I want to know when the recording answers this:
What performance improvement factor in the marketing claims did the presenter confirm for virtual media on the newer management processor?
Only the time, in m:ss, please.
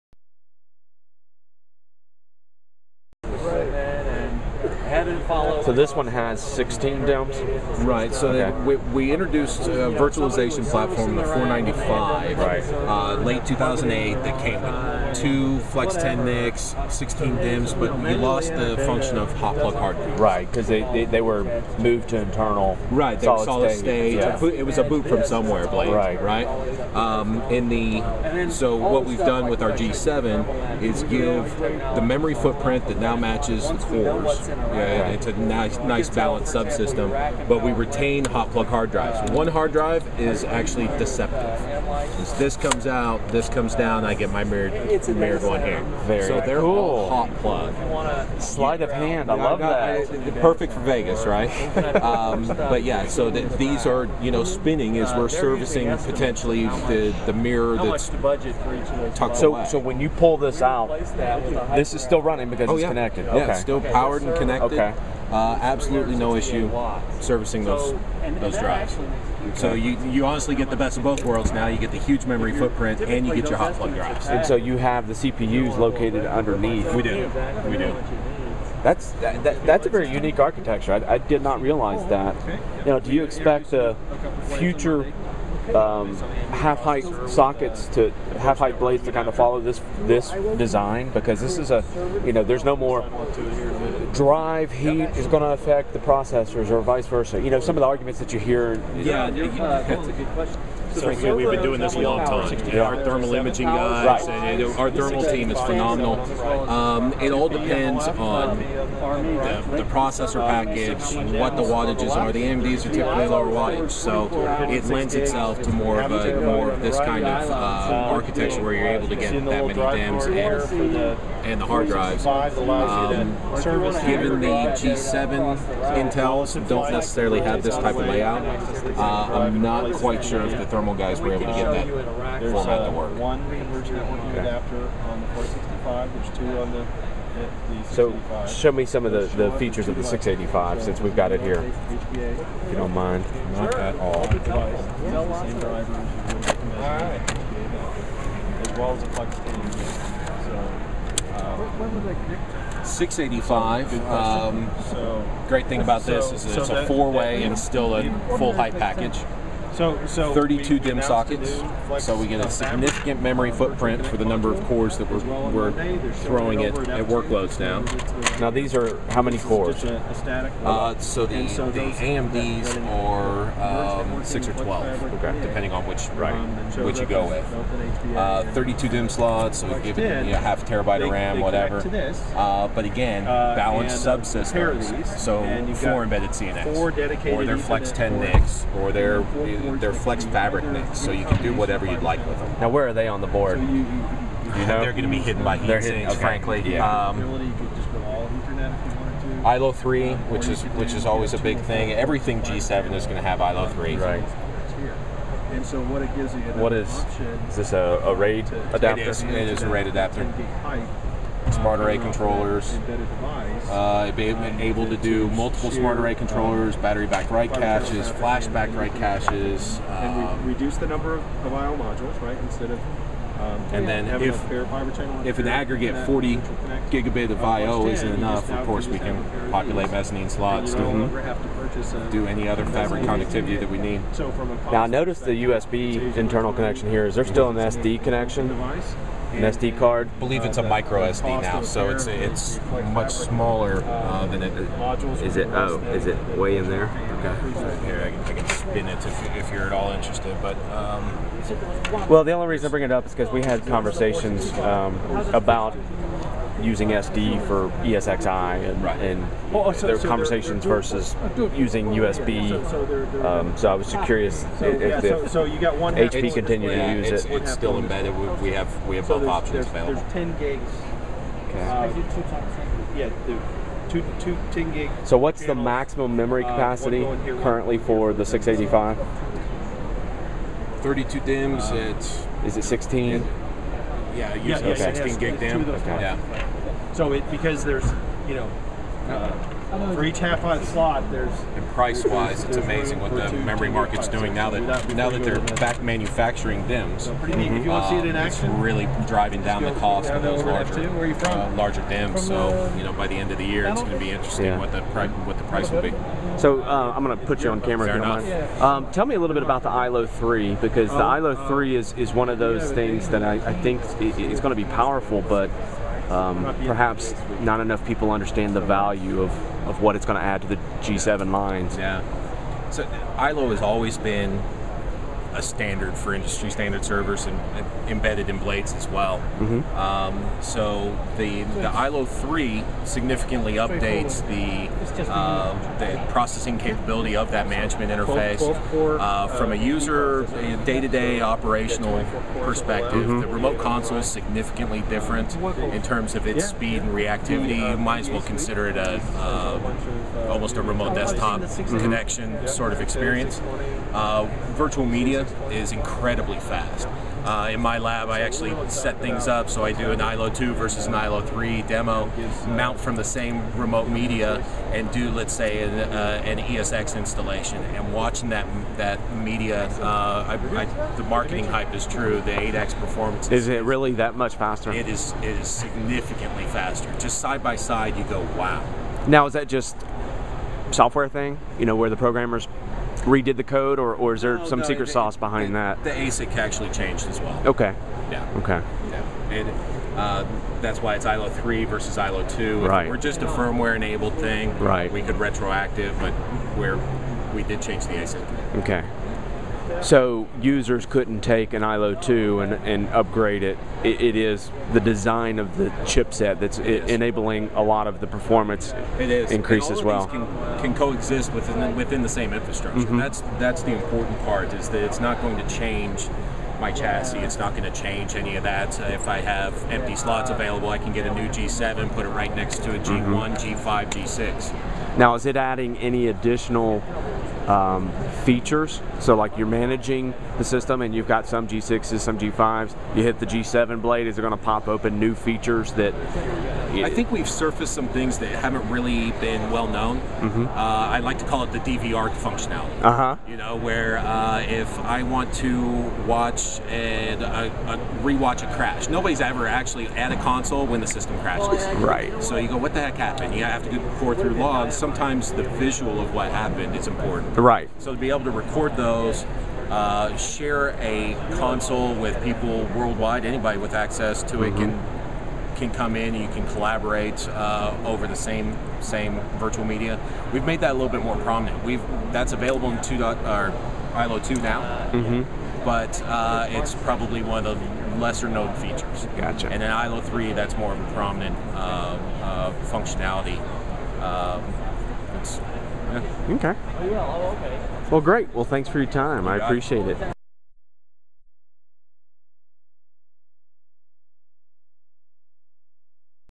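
6:12.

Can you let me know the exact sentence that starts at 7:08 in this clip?
So like you're managing the system and you've got some G6s, some G5s.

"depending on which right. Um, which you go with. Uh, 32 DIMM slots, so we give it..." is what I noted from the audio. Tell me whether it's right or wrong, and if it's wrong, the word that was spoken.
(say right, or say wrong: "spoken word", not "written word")
right.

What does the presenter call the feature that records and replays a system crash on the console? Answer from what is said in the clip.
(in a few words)
DVR functionality.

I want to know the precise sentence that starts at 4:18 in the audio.
and oh, oh so, their so conversations they're, oh, they're versus using USB.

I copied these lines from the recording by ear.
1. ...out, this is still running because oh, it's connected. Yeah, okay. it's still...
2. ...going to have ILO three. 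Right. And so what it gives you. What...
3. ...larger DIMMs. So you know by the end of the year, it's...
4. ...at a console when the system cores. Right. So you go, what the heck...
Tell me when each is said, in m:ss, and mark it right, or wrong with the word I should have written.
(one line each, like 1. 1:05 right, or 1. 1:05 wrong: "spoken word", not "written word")
1. 1:00 right
2. 3:23 right
3. 5:01 right
4. 7:29 wrong: "crashes", not "cores".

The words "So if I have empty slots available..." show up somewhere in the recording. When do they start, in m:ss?
6:58.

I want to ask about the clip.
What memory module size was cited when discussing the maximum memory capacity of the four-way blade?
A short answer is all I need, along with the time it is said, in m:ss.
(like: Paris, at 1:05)
16 gig, at 4:44.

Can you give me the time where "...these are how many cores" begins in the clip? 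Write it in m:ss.
2:48.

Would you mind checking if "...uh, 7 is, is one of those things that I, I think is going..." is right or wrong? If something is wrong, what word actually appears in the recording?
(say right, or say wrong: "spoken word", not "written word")
wrong: "3", not "7".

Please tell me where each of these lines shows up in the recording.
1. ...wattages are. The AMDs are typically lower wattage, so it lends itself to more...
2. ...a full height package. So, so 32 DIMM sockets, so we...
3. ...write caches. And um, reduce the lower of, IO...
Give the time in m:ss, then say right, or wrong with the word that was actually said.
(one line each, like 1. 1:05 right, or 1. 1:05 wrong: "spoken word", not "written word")
1. 1:51 right
2. 2:37 right
3. 3:38 wrong: "number", not "lower".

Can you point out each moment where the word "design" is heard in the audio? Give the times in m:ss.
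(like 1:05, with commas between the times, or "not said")
1:30, 6:44.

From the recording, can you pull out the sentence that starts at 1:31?
Because this is a you know, there's no more drive heat is going to affect the processors or vice versa?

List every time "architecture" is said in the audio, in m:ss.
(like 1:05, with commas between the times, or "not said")
1:20, 1:57.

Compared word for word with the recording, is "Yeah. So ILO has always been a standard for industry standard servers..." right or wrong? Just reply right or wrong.
right.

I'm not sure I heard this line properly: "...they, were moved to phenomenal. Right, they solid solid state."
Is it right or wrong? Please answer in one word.
wrong.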